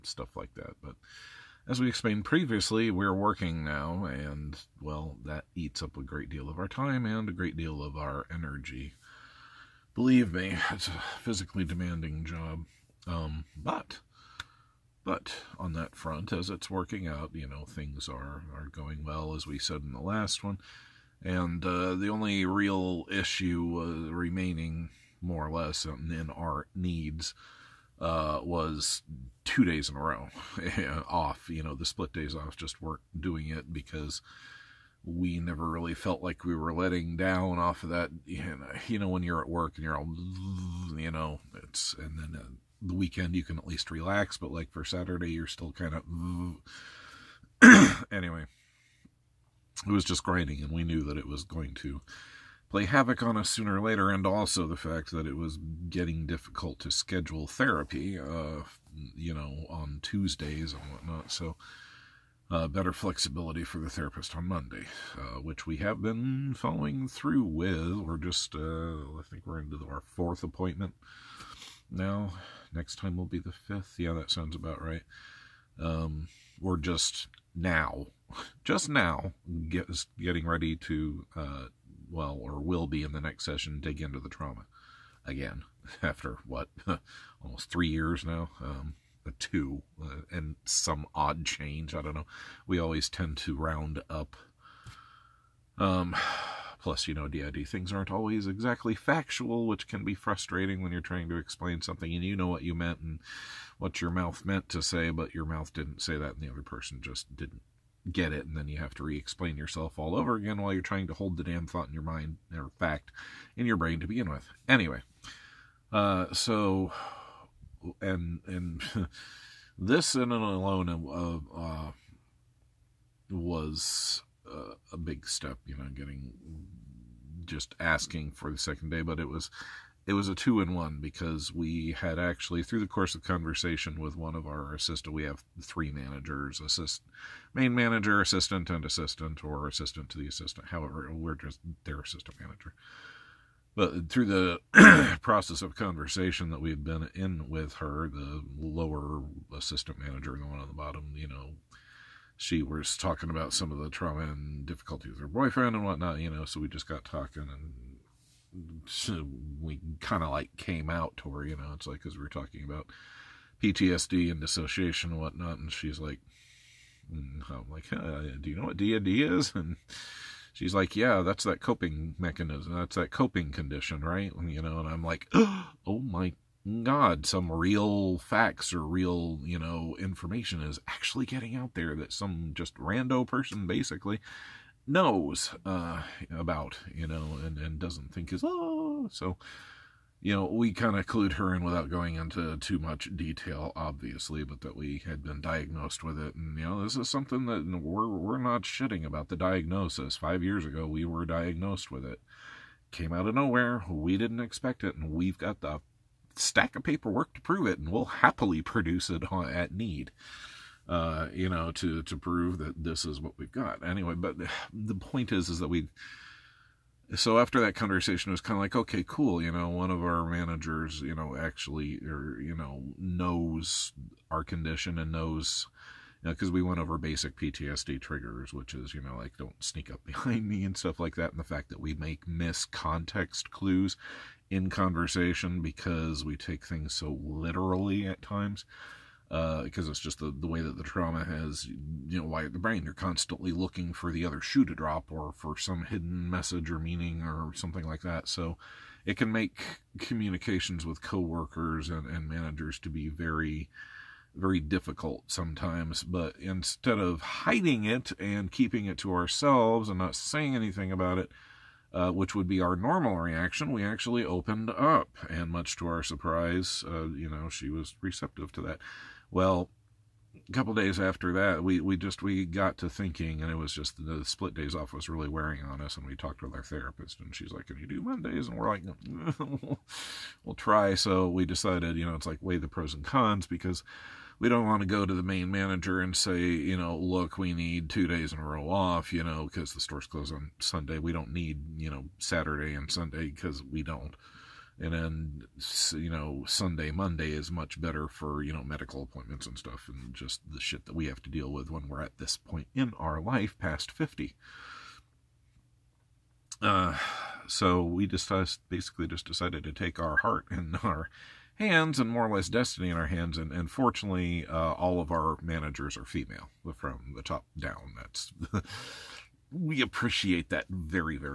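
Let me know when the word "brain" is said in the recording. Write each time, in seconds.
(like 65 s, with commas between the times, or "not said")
113 s, 242 s.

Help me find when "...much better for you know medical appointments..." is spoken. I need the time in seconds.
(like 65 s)
297 s.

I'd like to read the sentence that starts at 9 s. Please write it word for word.
Believe me, it's a physically demanding job.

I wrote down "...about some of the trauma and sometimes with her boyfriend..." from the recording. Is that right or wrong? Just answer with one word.
wrong.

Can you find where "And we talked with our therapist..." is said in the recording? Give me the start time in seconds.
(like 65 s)
275 s.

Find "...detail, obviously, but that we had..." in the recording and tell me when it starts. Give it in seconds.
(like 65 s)
193 s.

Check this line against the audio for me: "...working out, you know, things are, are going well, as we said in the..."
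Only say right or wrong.
right.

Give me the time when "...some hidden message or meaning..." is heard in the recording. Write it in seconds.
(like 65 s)
245 s.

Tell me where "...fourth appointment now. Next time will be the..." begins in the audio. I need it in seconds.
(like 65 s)
70 s.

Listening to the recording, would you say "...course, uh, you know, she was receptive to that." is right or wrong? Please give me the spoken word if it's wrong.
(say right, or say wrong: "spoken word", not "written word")
wrong: "surprise", not "course".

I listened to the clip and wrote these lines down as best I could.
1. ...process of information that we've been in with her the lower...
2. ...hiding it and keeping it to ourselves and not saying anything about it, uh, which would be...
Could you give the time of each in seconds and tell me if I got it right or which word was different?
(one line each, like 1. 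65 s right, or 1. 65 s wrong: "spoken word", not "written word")
1. 145 s wrong: "conversation", not "information"
2. 257 s right.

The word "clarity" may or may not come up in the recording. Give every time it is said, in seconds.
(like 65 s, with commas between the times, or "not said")
not said.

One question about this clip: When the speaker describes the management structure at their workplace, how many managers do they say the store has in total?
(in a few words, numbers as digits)
3.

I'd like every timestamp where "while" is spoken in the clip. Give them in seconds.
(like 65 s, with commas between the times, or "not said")
110 s.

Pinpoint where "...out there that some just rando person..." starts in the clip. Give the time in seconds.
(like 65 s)
181 s.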